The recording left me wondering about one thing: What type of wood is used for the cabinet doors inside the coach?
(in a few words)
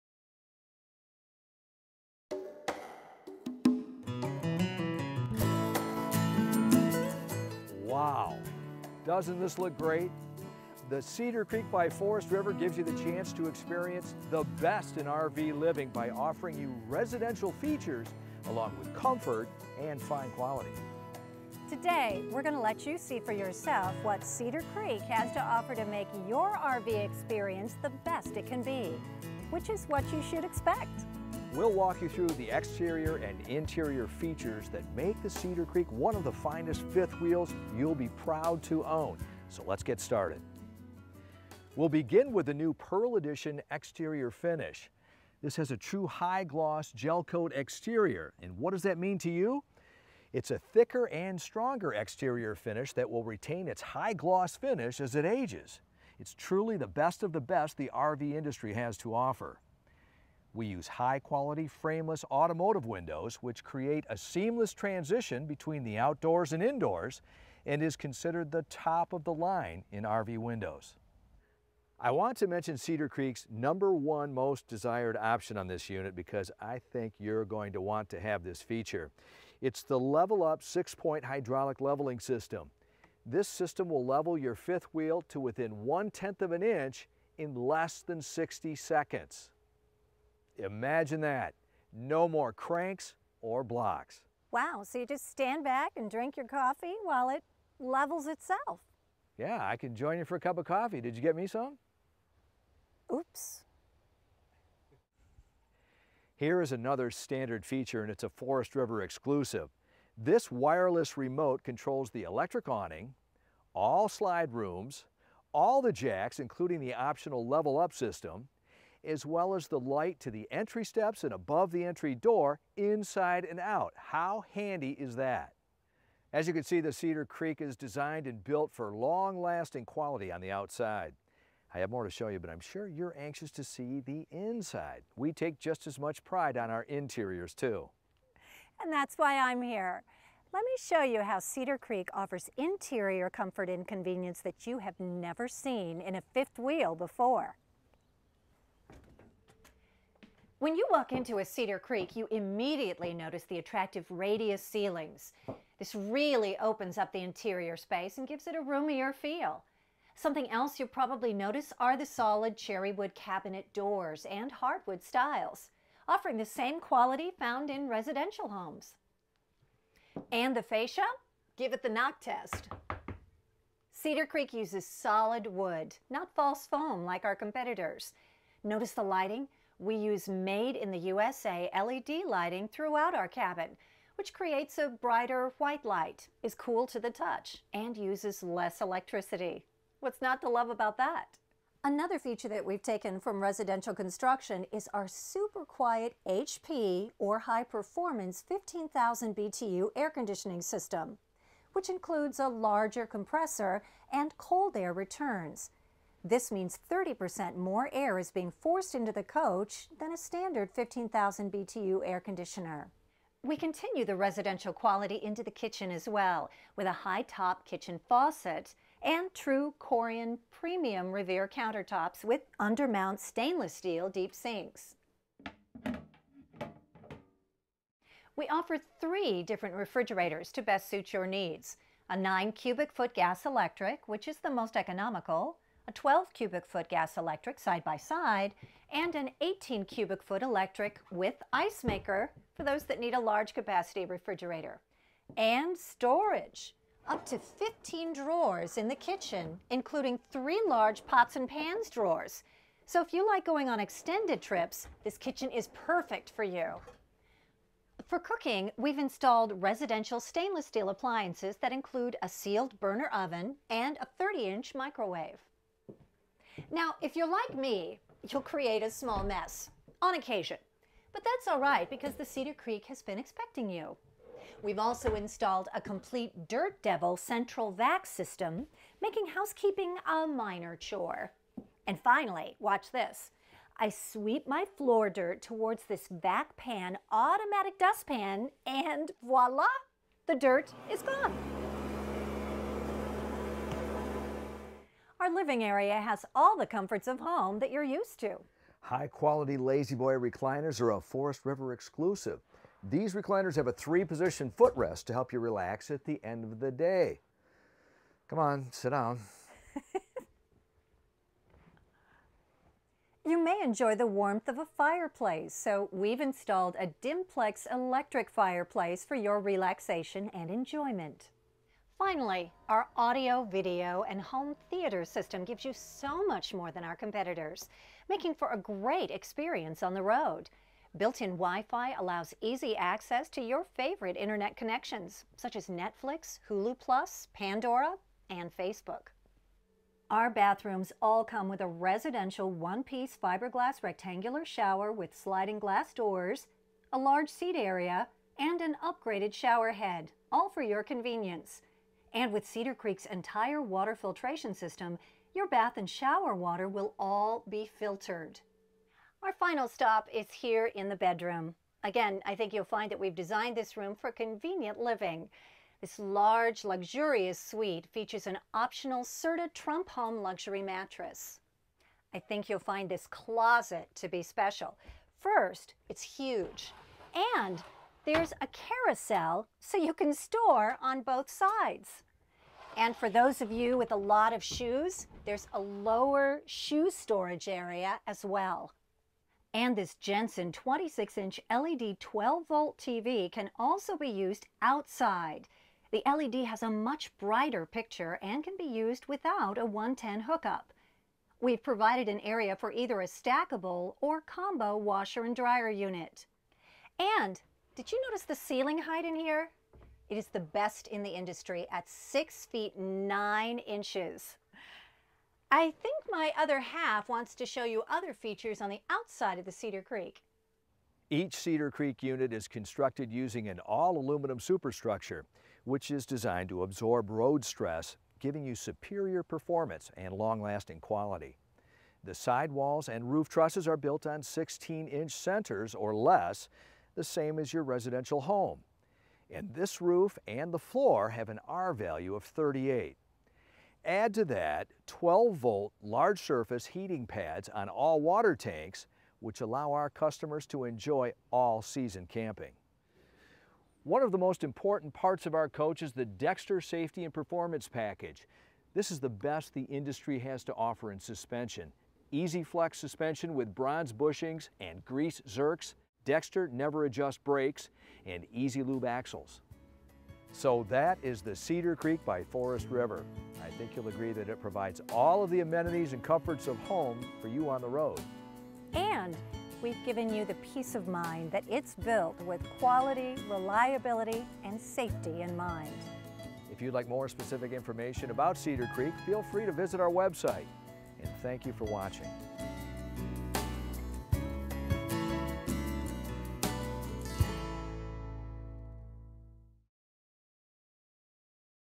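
cherry.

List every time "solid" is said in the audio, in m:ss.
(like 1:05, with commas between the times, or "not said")
2:42, 2:54.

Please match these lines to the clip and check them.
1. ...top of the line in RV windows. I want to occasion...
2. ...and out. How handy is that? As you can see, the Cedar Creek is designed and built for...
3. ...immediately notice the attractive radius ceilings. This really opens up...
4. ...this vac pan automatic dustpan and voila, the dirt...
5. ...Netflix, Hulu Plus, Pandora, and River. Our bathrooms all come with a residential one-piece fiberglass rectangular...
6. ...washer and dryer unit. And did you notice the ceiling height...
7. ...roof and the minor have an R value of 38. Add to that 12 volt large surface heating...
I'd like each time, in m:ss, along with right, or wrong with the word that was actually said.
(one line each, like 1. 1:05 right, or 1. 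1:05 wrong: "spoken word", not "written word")
1. 1:08 wrong: "mention", not "occasion"
2. 2:03 right
3. 2:32 right
4. 4:45 right
5. 5:35 wrong: "Facebook", not "River"
6. 6:44 right
7. 7:19 wrong: "floor", not "minor".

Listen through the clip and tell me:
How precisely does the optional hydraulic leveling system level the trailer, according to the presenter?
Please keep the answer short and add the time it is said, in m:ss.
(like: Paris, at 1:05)
one-tenth of an inch, at 1:25.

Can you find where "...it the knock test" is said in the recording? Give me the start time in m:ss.
2:51.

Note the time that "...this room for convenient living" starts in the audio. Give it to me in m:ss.
6:03.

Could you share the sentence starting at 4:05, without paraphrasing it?
And storage, up to 15 drawers in the kitchen, including three large pots and pans drawers.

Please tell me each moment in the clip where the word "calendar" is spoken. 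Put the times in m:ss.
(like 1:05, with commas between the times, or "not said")
not said.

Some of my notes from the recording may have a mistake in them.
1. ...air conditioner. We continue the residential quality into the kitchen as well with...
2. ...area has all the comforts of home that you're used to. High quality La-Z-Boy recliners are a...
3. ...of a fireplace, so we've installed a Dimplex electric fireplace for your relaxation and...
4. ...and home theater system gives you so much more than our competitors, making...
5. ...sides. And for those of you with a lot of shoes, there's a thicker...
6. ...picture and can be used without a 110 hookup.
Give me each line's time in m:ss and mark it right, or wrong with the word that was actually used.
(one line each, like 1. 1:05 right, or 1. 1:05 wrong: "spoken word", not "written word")
1. 3:32 right
2. 4:55 right
3. 5:14 right
4. 5:24 right
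5. 6:21 wrong: "lower", not "thicker"
6. 6:37 right.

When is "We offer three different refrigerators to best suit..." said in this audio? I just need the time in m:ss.
3:48.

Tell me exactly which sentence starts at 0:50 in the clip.
It's a thicker and stronger exterior finish that will retain its high gloss finish as it ages.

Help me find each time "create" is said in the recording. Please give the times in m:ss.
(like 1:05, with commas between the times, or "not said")
1:03, 3:04, 4:28.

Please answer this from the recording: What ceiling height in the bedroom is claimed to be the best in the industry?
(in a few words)
6 feet 9 inches.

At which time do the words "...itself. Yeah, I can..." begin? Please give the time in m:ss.
1:38.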